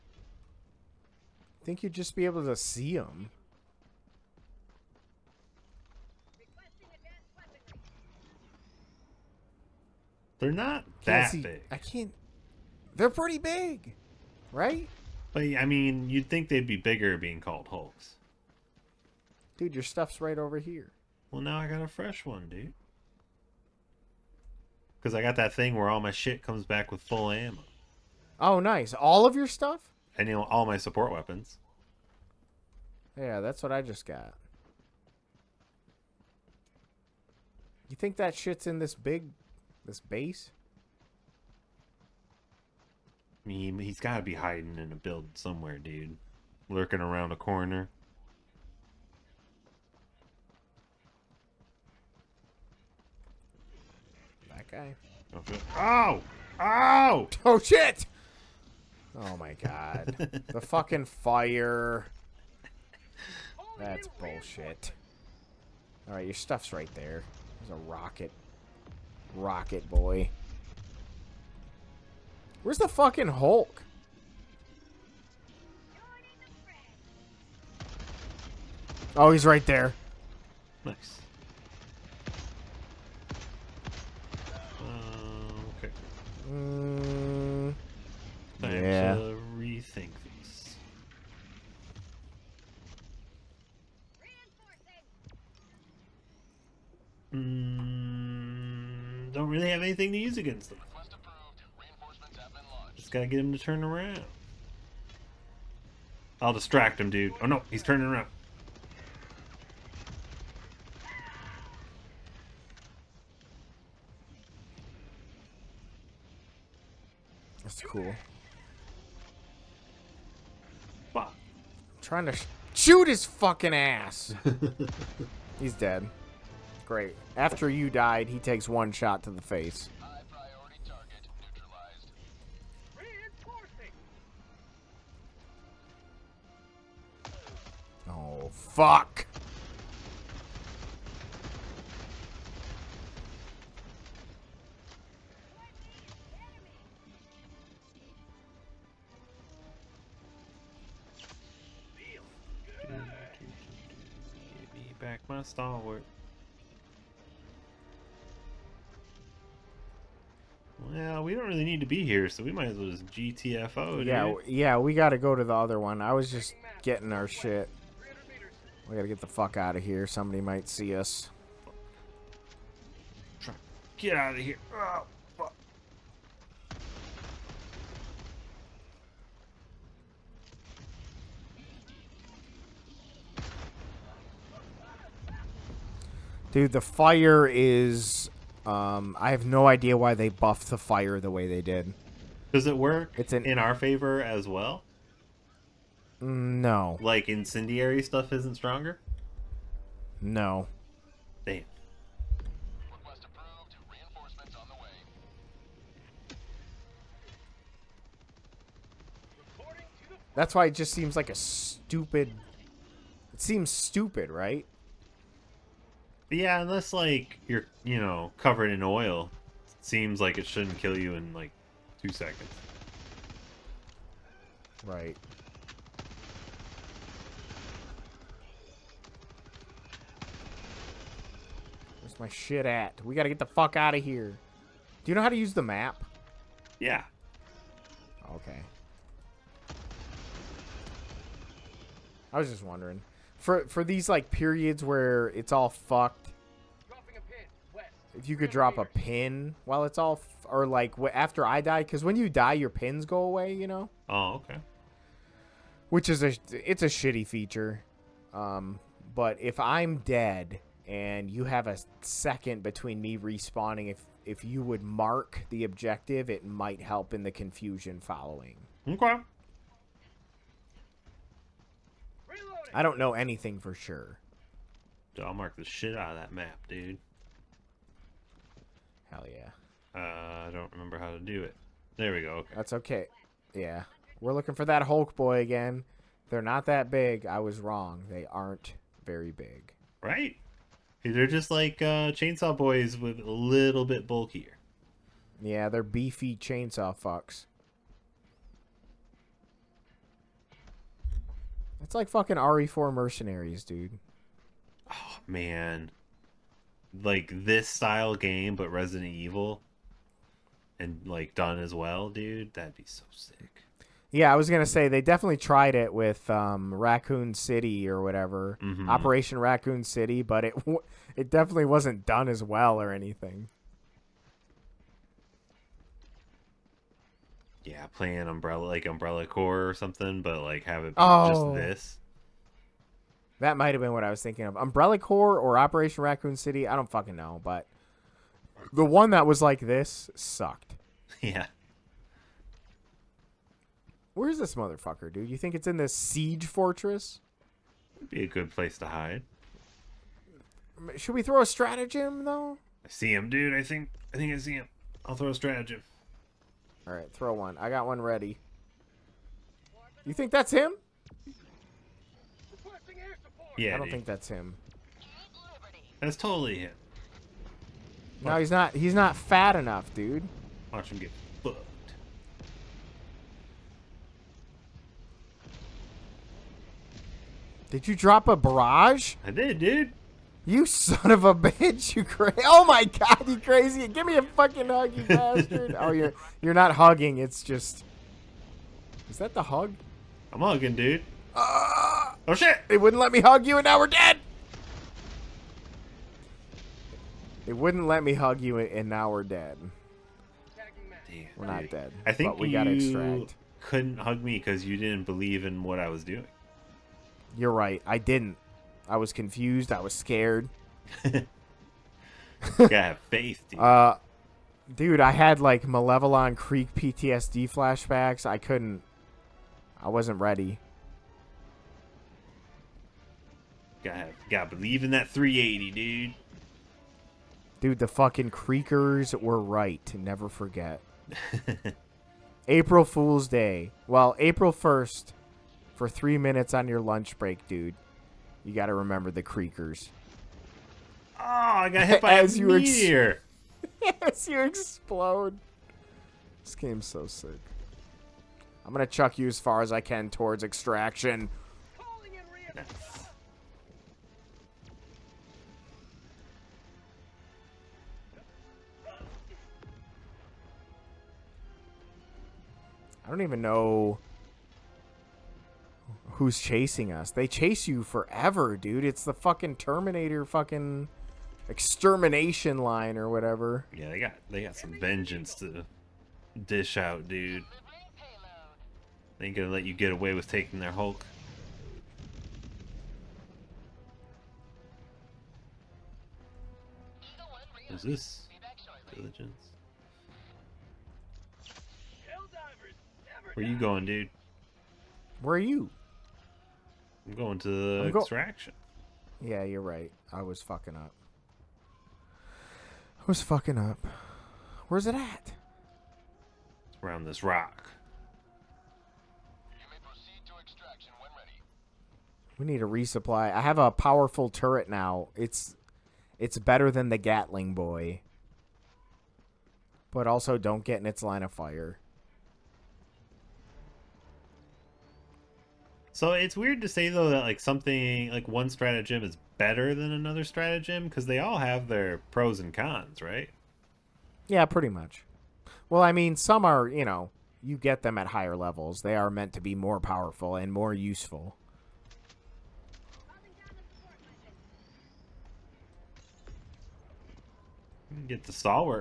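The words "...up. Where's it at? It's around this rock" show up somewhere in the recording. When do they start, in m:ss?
8:23.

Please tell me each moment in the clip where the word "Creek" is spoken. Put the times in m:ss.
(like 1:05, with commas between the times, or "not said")
6:56.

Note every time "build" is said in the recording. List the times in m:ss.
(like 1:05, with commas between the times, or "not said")
0:44.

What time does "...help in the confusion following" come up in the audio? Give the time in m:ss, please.
4:26.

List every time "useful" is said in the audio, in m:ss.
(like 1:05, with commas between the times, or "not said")
9:00.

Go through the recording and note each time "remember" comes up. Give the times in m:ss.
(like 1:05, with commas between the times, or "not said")
4:40, 7:18.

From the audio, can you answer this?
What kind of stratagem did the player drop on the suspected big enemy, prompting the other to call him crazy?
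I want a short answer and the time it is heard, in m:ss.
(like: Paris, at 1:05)
A barrage, at 6:18.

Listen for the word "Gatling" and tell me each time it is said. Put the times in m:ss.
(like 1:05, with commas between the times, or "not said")
8:36.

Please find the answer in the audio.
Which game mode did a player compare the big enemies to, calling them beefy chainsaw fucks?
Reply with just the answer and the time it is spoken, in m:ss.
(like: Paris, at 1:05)
RE4 Mercenaries, at 5:02.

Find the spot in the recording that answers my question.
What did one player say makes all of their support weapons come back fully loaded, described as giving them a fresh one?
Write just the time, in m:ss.
0:27.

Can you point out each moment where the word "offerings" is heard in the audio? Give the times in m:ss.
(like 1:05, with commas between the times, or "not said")
not said.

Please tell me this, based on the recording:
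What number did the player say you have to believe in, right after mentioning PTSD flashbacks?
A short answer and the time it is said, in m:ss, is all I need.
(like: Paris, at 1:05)
380, at 7:05.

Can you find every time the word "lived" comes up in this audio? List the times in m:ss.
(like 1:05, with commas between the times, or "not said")
not said.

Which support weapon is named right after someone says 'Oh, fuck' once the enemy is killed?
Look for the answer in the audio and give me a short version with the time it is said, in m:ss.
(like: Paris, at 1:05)
Stalwart, at 2:35.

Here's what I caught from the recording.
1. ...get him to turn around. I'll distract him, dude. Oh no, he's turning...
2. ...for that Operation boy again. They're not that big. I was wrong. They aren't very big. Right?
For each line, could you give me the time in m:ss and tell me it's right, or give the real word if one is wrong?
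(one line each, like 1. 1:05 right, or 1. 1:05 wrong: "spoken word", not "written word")
1. 1:43 right
2. 4:44 wrong: "Hulk", not "Operation".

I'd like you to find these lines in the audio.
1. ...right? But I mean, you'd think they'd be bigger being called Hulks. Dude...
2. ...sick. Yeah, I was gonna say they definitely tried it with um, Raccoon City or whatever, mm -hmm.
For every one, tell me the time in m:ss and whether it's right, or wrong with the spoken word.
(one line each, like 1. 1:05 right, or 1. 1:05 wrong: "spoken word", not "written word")
1. 0:14 right
2. 5:13 right.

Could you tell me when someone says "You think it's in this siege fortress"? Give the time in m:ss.
5:45.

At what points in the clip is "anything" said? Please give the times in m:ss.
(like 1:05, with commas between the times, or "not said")
1:39, 4:33, 5:22.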